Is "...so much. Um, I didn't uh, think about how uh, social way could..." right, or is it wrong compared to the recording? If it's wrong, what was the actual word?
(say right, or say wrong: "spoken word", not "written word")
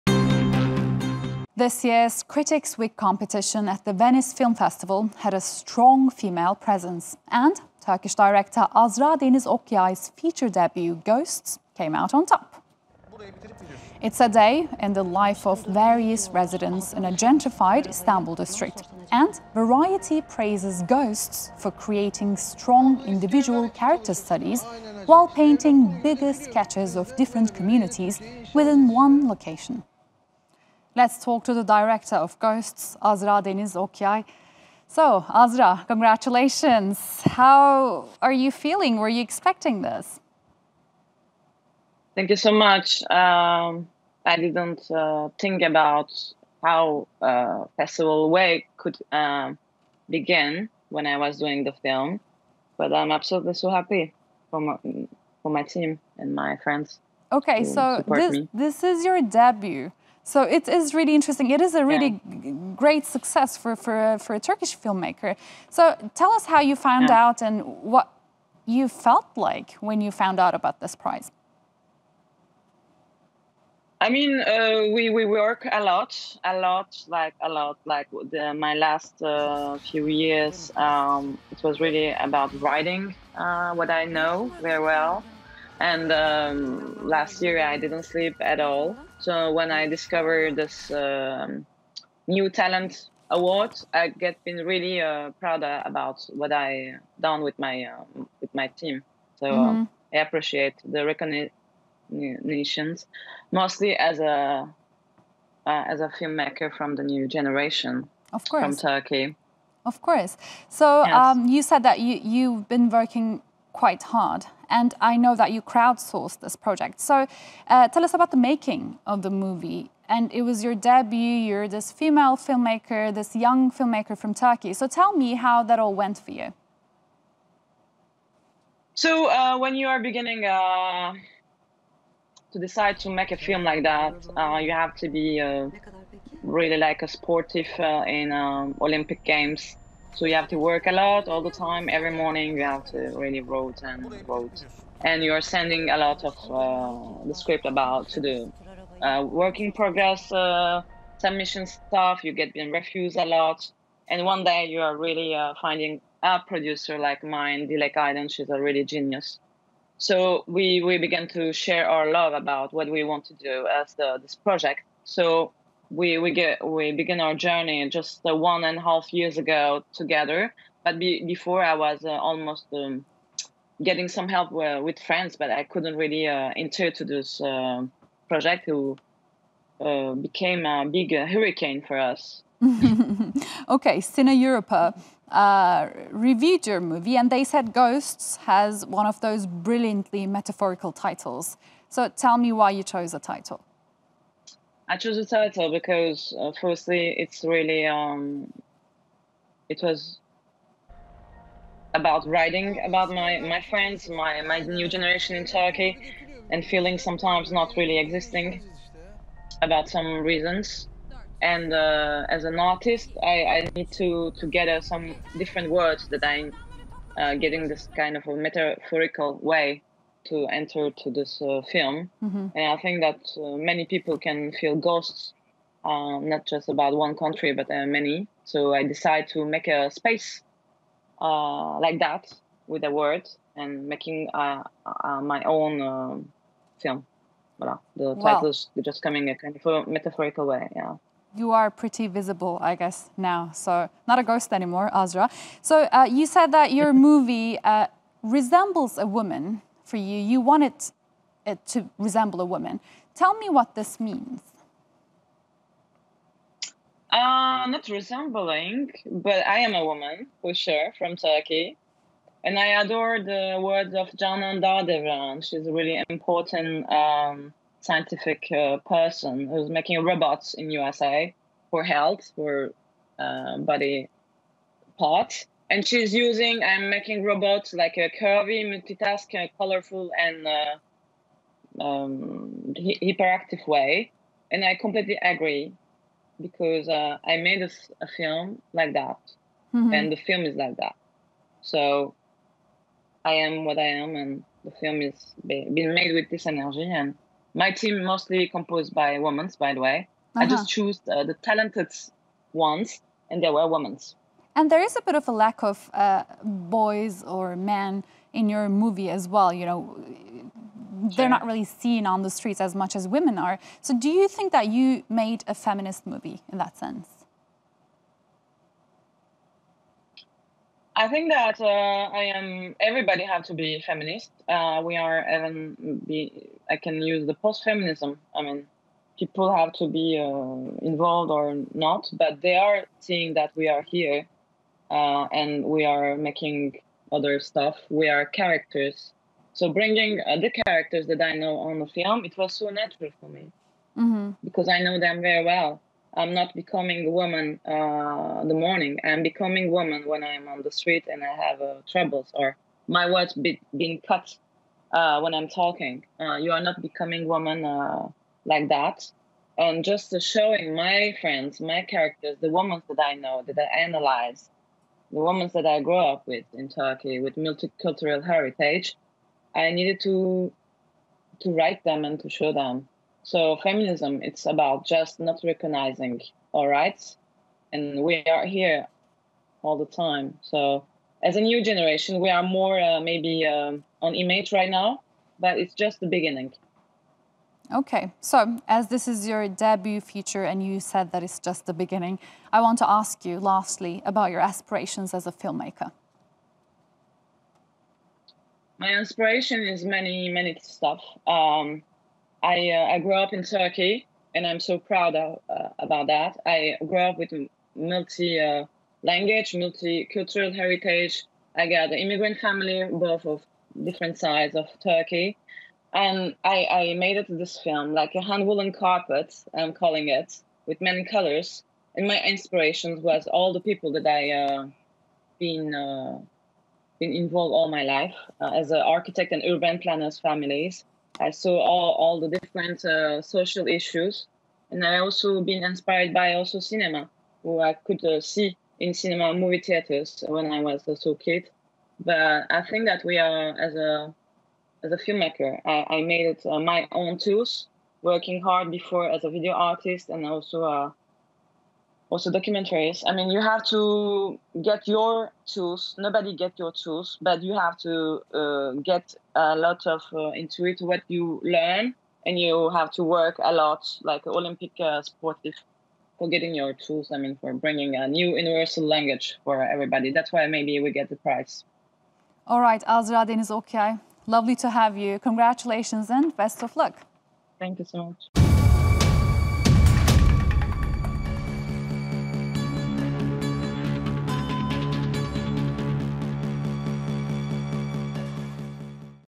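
wrong: "festival", not "social".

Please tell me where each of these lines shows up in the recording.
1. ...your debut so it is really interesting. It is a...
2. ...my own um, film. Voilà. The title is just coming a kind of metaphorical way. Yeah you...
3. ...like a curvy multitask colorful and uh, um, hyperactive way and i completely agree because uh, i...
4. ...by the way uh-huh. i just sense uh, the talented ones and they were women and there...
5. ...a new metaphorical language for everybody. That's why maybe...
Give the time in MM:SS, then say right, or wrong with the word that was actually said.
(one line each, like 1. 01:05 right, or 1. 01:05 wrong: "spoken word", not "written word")
1. 00:59 right
2. 03:55 right
3. 04:37 right
4. 04:59 wrong: "choose", not "sense"
5. 07:47 wrong: "universal", not "metaphorical".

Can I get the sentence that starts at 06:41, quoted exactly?
Um, I, uh, I grew up in Turkey and I'm so proud of, uh, about that.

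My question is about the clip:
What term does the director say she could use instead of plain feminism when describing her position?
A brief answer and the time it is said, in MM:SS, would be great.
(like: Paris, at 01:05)
post-feminism, at 05:27.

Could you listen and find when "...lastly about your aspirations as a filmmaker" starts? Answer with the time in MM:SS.
06:33.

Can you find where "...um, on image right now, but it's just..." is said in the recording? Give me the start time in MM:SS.
06:23.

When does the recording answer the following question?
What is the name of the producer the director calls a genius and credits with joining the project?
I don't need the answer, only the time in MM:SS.
02:37.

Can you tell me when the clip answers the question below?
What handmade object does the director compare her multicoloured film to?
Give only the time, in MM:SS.
06:58.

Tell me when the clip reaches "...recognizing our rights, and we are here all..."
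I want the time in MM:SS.
06:15.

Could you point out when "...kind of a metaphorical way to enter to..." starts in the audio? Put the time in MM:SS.
03:37.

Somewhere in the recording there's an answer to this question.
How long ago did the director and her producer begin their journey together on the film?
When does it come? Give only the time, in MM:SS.
02:48.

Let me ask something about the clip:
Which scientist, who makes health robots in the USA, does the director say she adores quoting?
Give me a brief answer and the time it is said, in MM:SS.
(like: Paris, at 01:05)
Canan Dağdeviren, at 04:24.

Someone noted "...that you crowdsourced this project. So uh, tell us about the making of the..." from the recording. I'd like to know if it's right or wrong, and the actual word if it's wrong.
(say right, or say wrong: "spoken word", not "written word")
right.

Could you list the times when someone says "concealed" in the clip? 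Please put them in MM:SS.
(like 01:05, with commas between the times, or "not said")
not said.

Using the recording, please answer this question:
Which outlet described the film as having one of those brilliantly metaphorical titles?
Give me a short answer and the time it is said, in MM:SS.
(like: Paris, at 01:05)
Cineuropa, at 03:03.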